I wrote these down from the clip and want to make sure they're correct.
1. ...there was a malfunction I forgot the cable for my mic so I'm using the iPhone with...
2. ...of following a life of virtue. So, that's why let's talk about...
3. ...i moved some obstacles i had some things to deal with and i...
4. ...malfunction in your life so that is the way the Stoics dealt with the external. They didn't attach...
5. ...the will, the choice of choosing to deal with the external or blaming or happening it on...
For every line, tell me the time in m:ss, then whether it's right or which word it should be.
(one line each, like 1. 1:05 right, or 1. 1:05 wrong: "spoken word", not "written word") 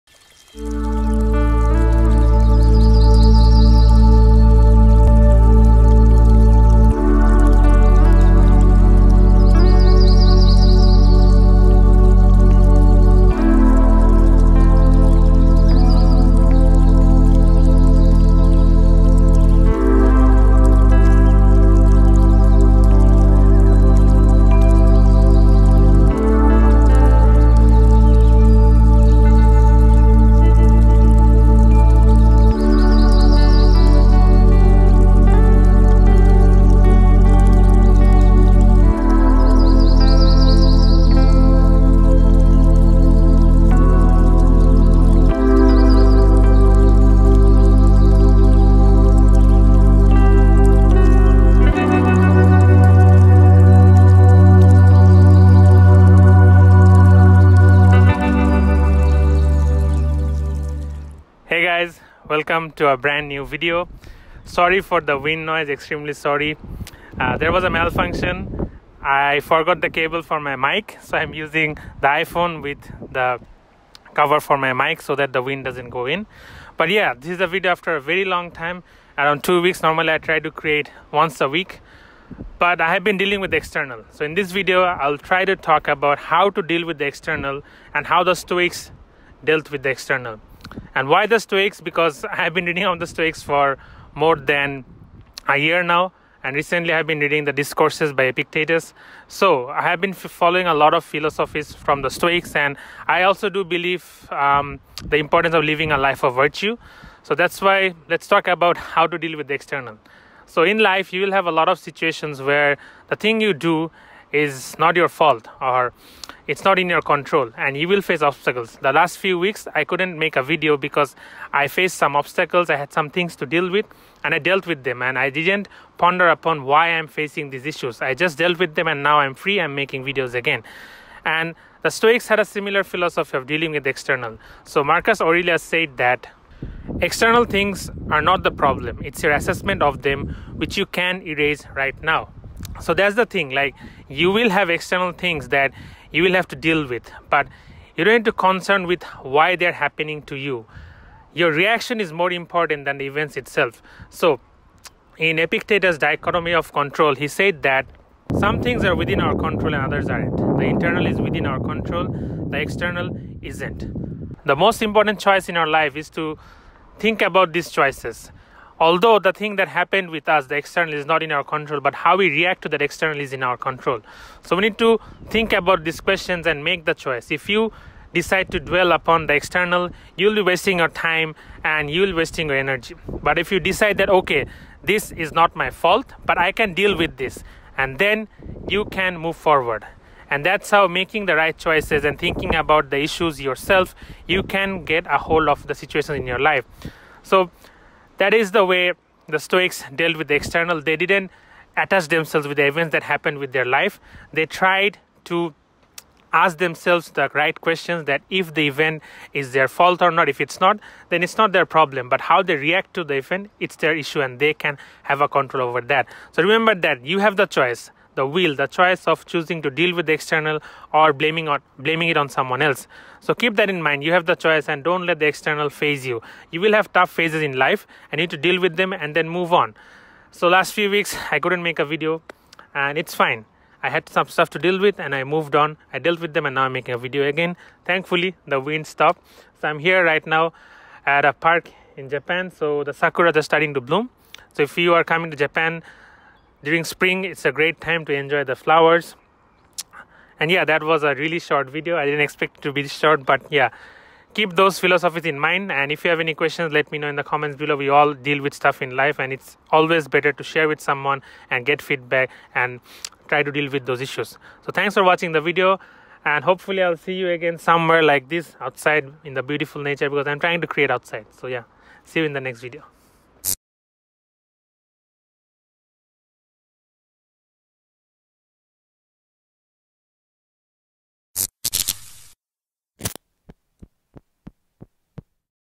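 1. 1:07 right
2. 1:45 wrong: "living", not "following"
3. 2:01 wrong: "faced", not "moved"
4. 3:15 wrong: "situation", not "malfunction"
5. 3:38 wrong: "blaming", not "happening".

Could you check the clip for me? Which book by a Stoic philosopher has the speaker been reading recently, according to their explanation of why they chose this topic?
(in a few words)
The Discourses.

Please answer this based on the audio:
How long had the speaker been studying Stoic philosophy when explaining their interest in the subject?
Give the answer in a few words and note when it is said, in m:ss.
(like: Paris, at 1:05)
More than a year, at 1:34.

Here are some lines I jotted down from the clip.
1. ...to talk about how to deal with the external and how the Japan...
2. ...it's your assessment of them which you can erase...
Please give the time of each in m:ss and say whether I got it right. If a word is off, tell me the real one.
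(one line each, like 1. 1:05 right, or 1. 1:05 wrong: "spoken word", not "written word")
1. 1:25 wrong: "Stoics", not "Japan"
2. 2:19 right.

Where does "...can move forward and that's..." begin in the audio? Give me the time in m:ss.
3:08.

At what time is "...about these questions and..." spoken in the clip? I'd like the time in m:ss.
2:55.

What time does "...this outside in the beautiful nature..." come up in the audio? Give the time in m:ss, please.
4:28.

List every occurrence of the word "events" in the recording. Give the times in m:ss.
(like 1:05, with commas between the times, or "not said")
2:33, 3:22, 3:28, 3:33.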